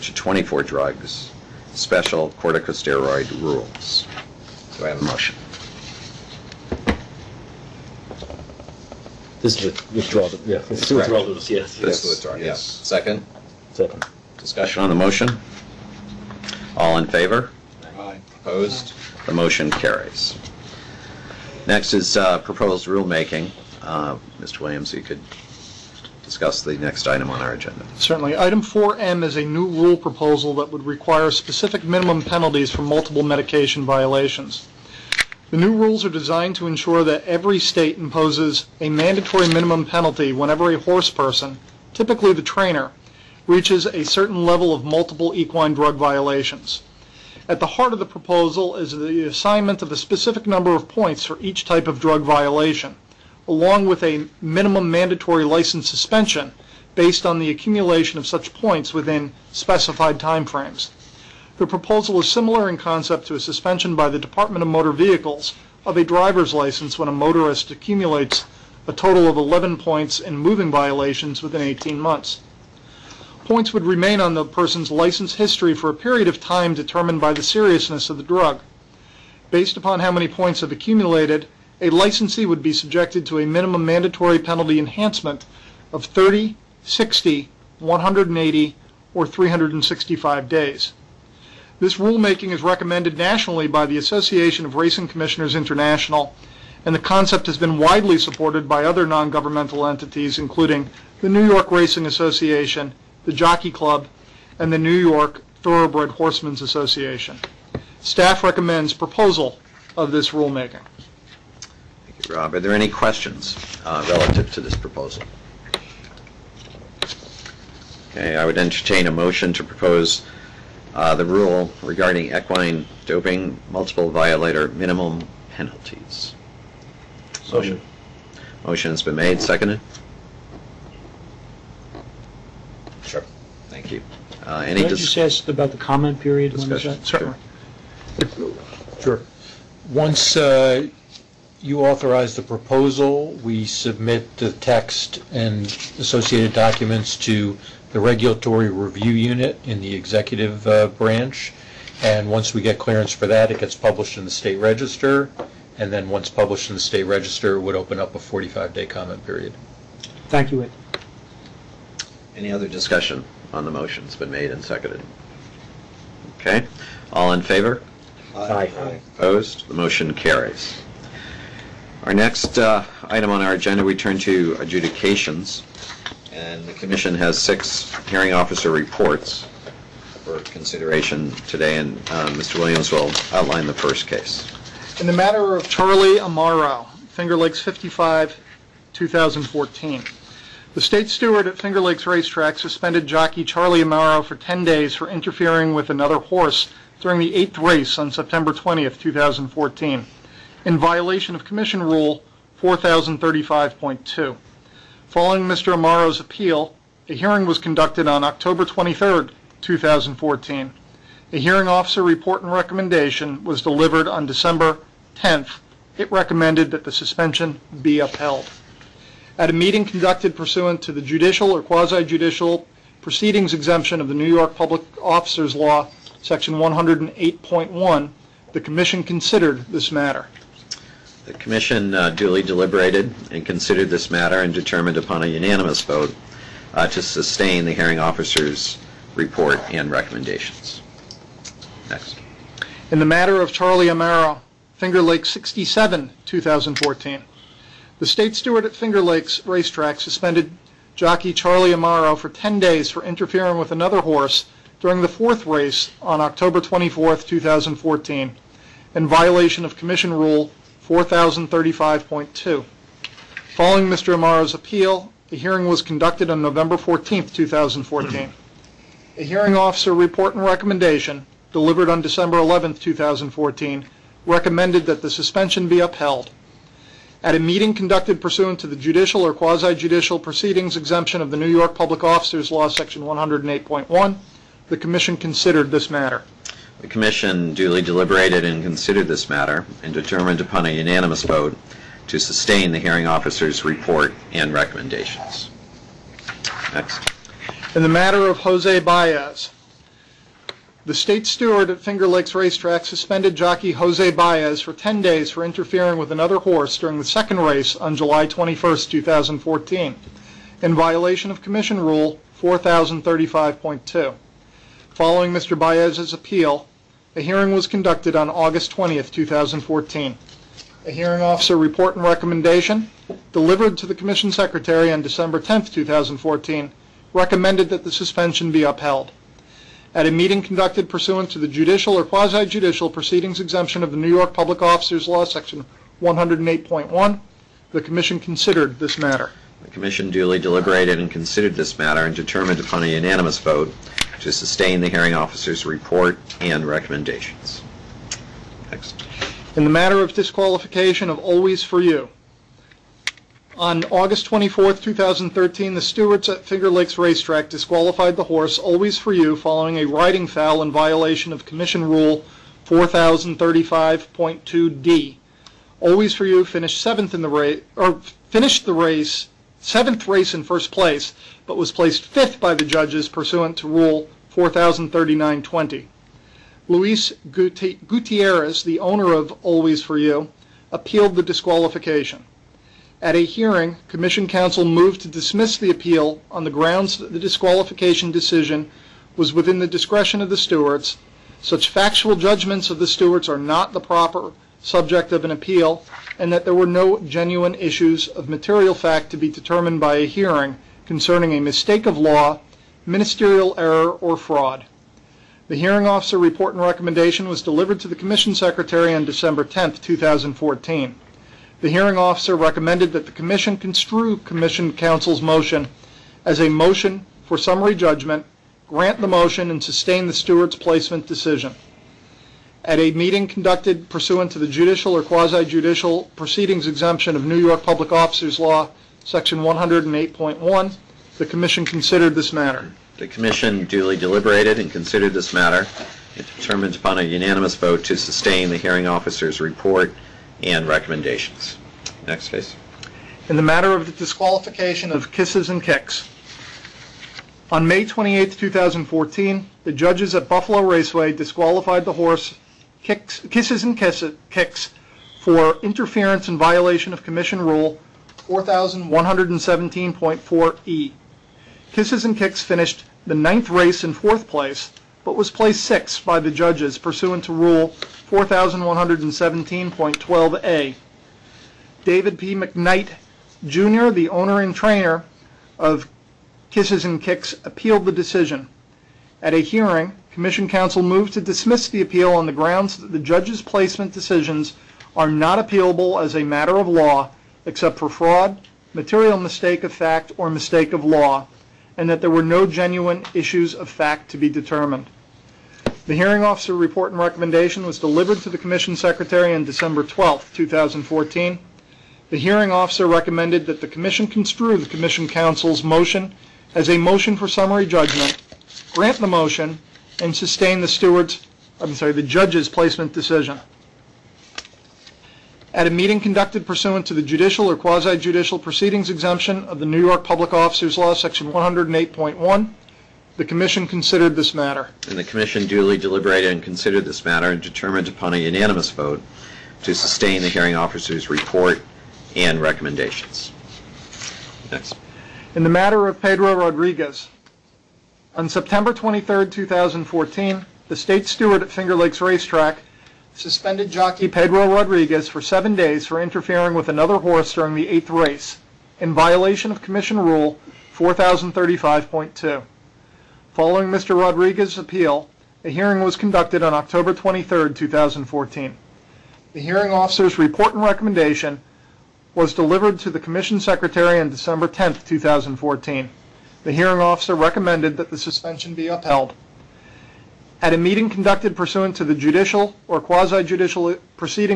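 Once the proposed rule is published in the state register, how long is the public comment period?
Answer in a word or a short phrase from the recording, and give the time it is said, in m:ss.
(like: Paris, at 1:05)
45 days, at 2:38.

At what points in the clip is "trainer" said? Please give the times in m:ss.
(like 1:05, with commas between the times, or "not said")
0:42, 7:54.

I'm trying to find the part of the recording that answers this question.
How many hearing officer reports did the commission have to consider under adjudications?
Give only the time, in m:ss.
2:57.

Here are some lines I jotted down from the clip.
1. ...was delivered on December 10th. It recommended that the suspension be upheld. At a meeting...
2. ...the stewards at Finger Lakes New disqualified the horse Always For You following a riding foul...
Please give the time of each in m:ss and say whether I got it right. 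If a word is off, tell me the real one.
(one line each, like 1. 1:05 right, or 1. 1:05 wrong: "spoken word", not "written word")
1. 3:33 right
2. 5:55 wrong: "Racetrack", not "New".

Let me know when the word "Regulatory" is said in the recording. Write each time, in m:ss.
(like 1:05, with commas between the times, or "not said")
2:27.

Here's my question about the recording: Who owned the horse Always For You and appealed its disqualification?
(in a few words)
Luis Gutierrez.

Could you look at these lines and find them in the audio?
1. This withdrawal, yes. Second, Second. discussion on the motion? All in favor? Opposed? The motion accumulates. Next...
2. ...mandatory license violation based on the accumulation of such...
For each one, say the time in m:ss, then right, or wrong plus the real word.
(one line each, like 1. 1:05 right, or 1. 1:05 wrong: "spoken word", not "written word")
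1. 0:11 wrong: "carries", not "accumulates"
2. 0:54 wrong: "suspension", not "violation".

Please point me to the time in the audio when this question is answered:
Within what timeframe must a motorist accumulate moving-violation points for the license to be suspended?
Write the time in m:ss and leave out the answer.
1:11.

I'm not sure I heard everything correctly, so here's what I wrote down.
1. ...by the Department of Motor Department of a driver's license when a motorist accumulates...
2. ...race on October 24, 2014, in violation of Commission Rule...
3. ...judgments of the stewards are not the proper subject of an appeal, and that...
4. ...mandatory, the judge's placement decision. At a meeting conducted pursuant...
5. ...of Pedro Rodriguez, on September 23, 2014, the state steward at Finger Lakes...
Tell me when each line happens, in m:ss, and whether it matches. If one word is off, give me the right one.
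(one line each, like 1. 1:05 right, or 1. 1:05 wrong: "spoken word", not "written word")
1. 1:03 wrong: "Vehicles", not "Department"
2. 4:15 right
3. 6:32 right
4. 8:31 wrong: "sorry", not "mandatory"
5. 8:55 right.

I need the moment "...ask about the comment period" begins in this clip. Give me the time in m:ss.
2:15.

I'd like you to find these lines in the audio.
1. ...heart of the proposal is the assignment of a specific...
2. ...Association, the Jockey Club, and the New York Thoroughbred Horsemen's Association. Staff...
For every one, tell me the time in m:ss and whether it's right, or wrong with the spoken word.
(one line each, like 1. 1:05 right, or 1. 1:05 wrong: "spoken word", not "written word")
1. 0:47 right
2. 1:42 right.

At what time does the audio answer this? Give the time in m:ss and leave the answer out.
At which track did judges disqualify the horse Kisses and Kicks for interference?
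7:30.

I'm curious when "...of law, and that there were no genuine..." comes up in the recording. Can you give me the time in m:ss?
8:10.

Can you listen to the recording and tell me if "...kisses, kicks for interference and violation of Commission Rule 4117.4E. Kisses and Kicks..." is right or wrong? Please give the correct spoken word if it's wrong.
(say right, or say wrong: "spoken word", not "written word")
right.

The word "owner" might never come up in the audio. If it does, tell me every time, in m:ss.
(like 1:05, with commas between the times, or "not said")
6:18, 7:54.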